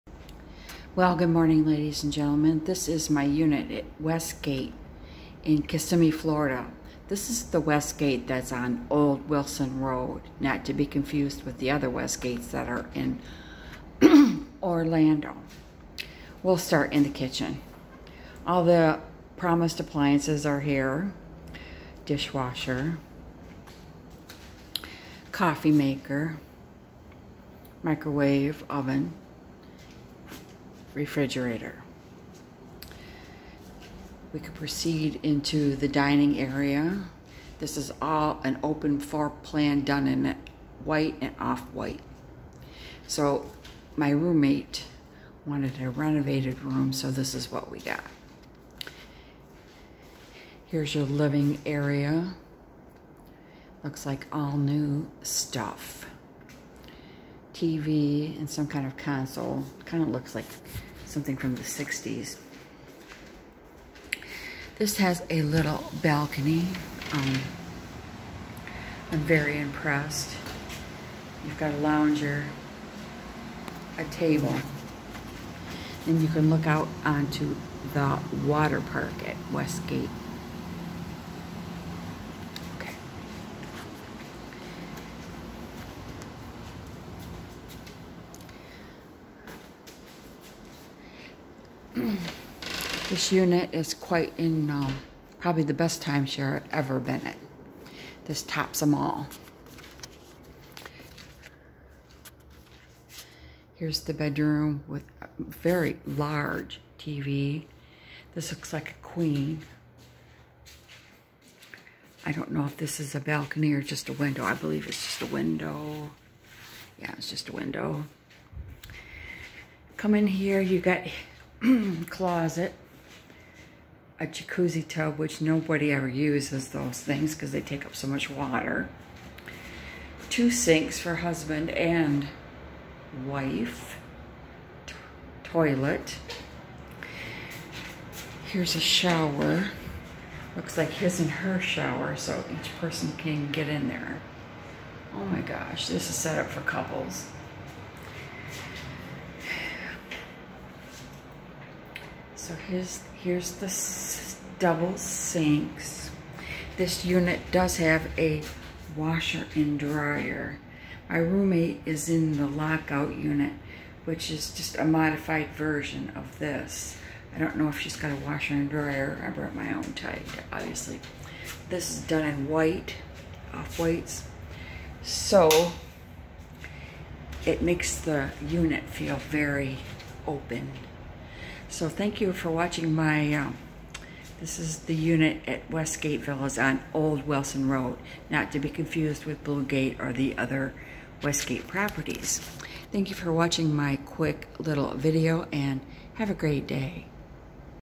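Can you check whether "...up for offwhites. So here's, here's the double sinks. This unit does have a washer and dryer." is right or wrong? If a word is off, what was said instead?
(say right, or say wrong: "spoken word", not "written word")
wrong: "couples", not "offwhites".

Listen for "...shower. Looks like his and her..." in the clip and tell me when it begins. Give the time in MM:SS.
02:18.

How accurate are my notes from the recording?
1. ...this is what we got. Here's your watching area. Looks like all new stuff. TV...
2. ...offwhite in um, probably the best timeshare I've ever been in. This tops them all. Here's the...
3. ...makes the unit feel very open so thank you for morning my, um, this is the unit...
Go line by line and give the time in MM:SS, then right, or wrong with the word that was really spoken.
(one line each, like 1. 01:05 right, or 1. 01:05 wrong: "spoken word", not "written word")
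1. 00:47 wrong: "living", not "watching"
2. 01:33 wrong: "quite", not "offwhite"
3. 02:57 wrong: "watching", not "morning".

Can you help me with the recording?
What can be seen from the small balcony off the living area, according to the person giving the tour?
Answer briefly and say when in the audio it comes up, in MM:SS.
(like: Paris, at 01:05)
The water park, at 01:18.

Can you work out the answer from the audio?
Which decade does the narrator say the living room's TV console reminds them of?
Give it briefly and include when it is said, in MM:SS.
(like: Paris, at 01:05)
the 60s, at 01:01.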